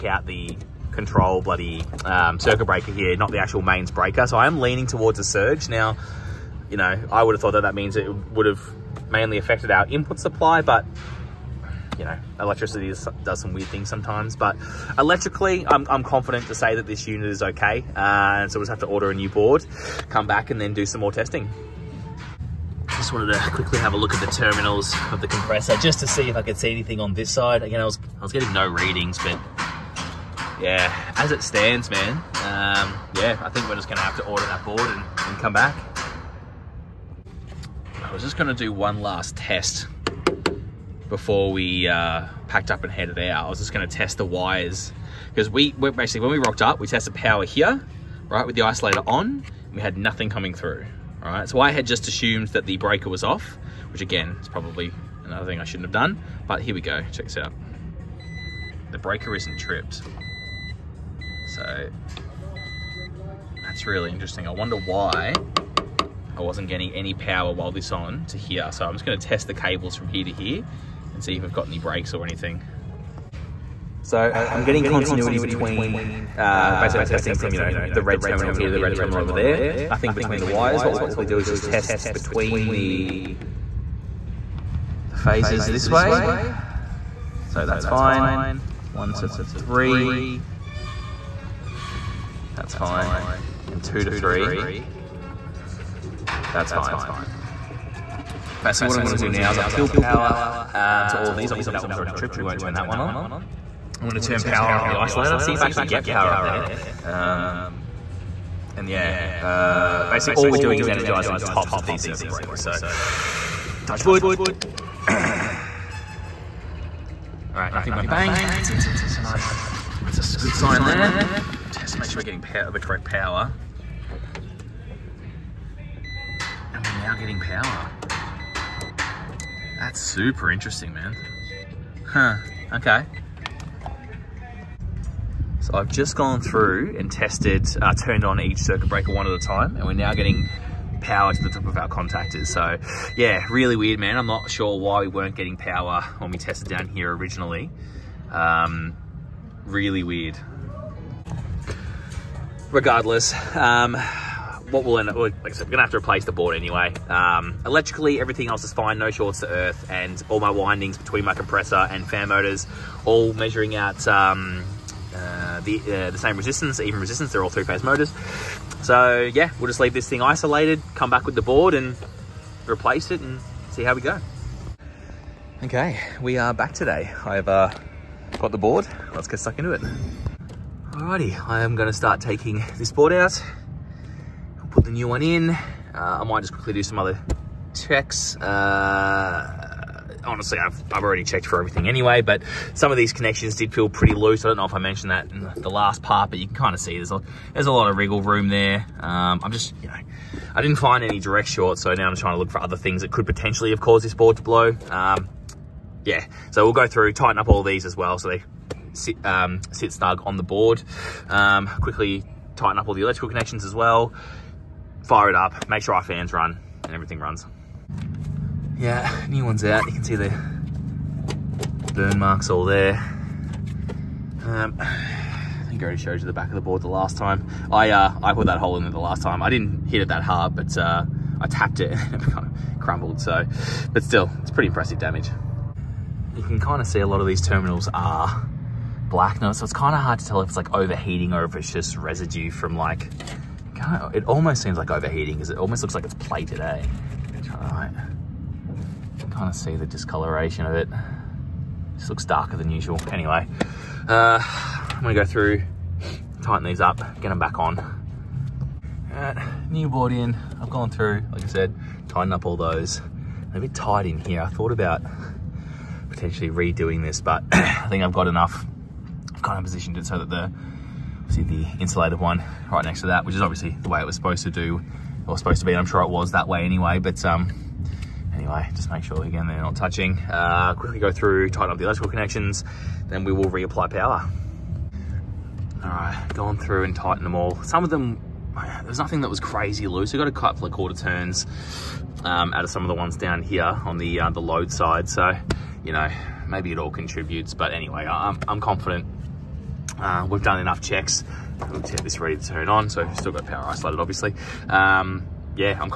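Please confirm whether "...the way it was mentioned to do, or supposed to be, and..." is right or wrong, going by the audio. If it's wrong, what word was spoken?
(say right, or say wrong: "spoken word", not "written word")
wrong: "supposed", not "mentioned".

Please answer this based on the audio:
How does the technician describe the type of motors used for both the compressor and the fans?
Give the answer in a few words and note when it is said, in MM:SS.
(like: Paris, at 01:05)
Three-phase motors, at 02:47.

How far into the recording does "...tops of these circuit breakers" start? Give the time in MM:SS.
01:51.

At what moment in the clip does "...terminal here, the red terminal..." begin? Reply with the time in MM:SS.
01:18.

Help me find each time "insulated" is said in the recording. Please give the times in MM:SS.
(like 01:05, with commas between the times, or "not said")
04:31.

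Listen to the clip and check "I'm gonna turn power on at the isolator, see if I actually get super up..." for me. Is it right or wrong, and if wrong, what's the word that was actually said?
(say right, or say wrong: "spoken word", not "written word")
wrong: "power", not "super".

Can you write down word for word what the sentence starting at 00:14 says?
But electrically, I'm, I'm confident to say that this unit is okay.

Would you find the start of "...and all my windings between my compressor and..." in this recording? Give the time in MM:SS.
02:39.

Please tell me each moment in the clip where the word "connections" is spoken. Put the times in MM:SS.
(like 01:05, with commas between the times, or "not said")
03:13, 03:33, 04:42.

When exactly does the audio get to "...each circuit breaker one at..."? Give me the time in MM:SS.
02:18.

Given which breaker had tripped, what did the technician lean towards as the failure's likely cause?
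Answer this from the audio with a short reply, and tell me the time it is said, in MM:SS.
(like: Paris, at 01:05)
A surge, at 00:05.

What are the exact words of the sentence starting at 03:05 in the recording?
Uh, I might just quickly do some other checks.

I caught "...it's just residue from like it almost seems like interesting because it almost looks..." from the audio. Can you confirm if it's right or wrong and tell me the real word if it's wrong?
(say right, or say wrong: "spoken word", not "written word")
wrong: "overheating", not "interesting".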